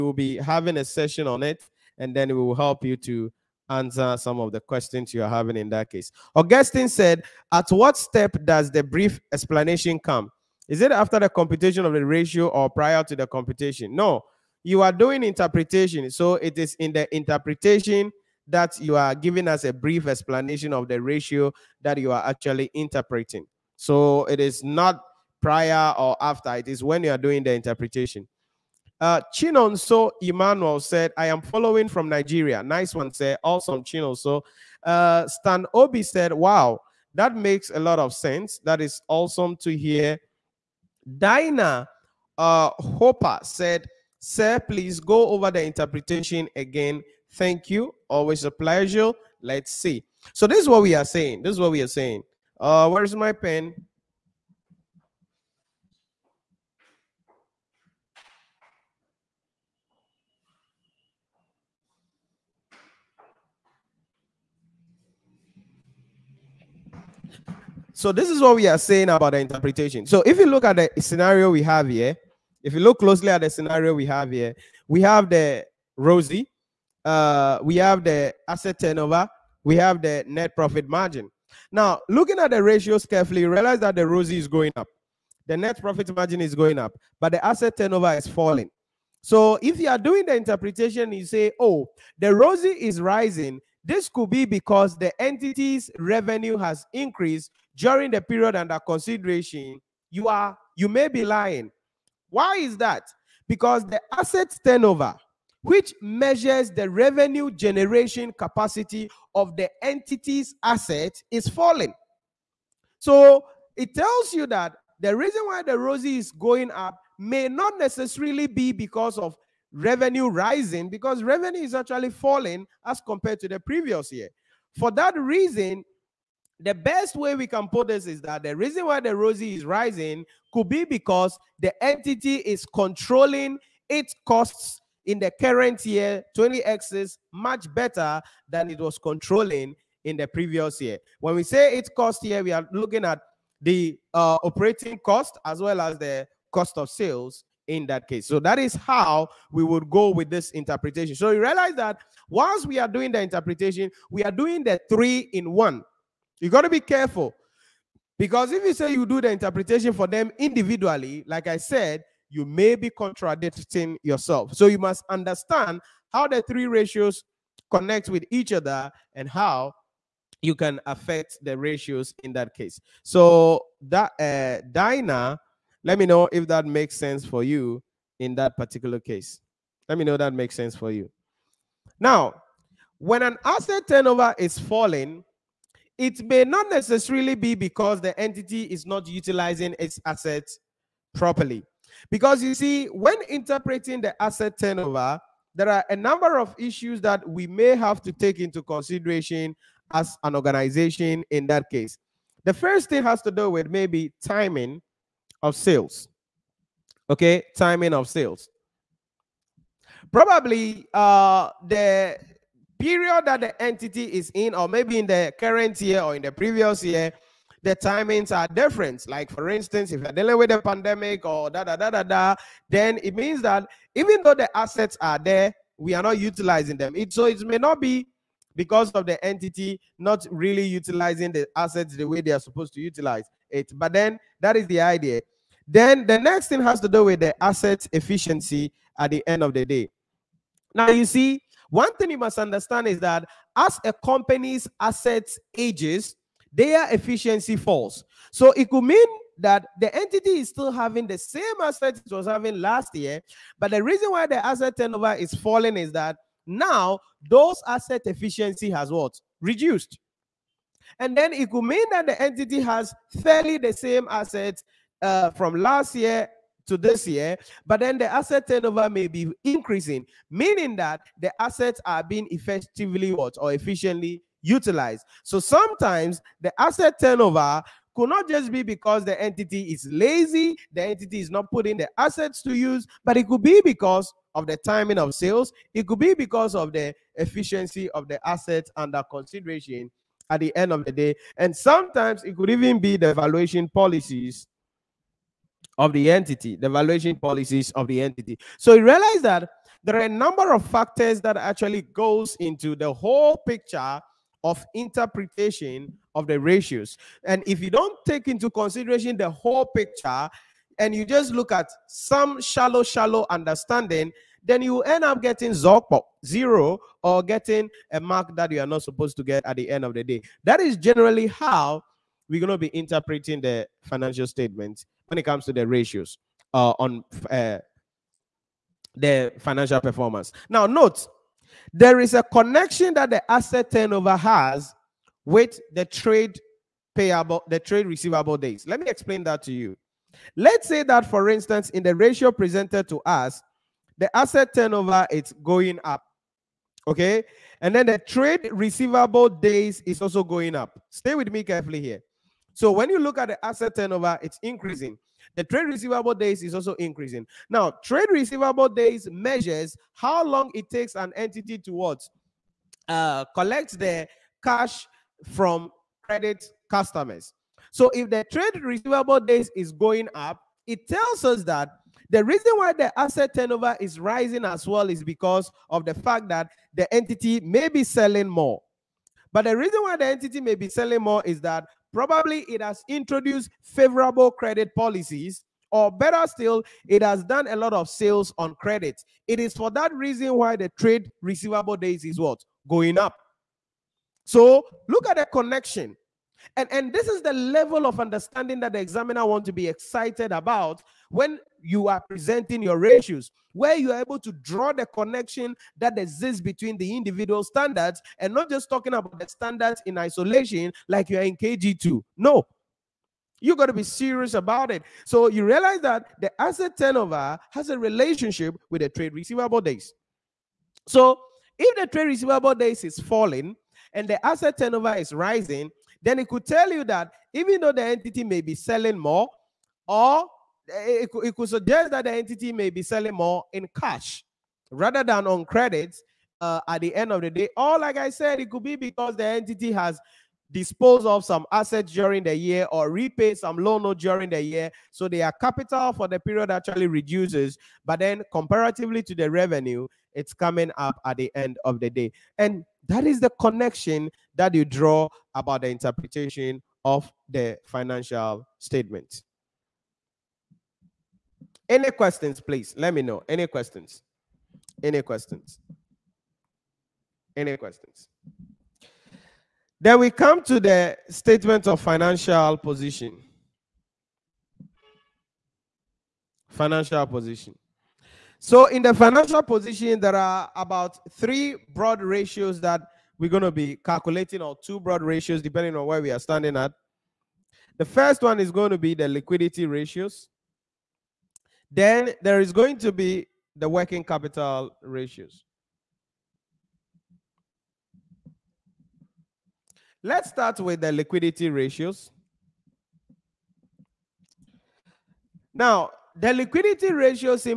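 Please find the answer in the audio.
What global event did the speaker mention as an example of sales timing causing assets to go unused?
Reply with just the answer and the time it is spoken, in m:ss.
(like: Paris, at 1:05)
A pandemic, at 3:40.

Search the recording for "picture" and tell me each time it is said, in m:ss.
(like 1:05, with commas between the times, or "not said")
5:03, 5:09.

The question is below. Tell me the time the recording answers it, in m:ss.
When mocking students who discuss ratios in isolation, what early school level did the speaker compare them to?
6:51.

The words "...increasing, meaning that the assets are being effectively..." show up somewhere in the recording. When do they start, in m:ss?
4:29.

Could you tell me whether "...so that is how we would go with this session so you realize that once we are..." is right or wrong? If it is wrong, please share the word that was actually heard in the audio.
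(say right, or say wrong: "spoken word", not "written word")
wrong: "interpretation", not "session".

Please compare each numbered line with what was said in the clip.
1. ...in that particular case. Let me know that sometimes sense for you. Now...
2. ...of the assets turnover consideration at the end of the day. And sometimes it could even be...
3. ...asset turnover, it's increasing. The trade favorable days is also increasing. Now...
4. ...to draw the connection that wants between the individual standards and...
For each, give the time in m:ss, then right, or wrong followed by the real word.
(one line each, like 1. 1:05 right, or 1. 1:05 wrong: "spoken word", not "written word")
1. 2:58 wrong: "makes", not "sometimes"
2. 4:47 wrong: "under", not "turnover"
3. 5:53 wrong: "receivable", not "favorable"
4. 6:44 wrong: "exists", not "wants".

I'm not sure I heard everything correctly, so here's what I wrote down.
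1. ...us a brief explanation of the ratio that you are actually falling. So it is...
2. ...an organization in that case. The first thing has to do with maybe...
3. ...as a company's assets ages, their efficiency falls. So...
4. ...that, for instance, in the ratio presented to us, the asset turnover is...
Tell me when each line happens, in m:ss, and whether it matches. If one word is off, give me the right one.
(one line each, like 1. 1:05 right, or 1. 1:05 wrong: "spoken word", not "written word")
1. 0:19 wrong: "interpreting", not "falling"
2. 3:20 right
3. 4:03 right
4. 5:40 right.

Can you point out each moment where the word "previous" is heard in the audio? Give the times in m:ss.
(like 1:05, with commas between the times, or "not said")
2:03, 2:20, 3:36.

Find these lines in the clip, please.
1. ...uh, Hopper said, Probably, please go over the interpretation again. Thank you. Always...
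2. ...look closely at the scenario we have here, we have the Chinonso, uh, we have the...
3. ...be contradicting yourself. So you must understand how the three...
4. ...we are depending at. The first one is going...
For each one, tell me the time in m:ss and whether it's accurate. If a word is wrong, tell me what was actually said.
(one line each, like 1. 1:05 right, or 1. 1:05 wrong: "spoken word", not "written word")
1. 0:42 wrong: "Sir", not "Probably"
2. 1:12 wrong: "ROCE", not "Chinonso"
3. 2:42 right
4. 8:06 wrong: "standing", not "depending".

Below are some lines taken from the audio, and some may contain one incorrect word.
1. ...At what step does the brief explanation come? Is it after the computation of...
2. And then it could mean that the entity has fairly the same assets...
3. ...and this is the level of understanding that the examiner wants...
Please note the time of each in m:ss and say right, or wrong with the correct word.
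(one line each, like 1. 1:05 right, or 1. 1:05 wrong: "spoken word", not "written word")
1. 0:07 right
2. 4:20 right
3. 6:36 right.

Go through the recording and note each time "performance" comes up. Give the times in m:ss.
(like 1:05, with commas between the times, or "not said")
5:29.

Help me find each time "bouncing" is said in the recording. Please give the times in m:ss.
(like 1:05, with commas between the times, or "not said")
not said.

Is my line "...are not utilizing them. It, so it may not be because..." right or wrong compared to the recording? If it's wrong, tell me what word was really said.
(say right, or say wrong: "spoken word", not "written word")
right.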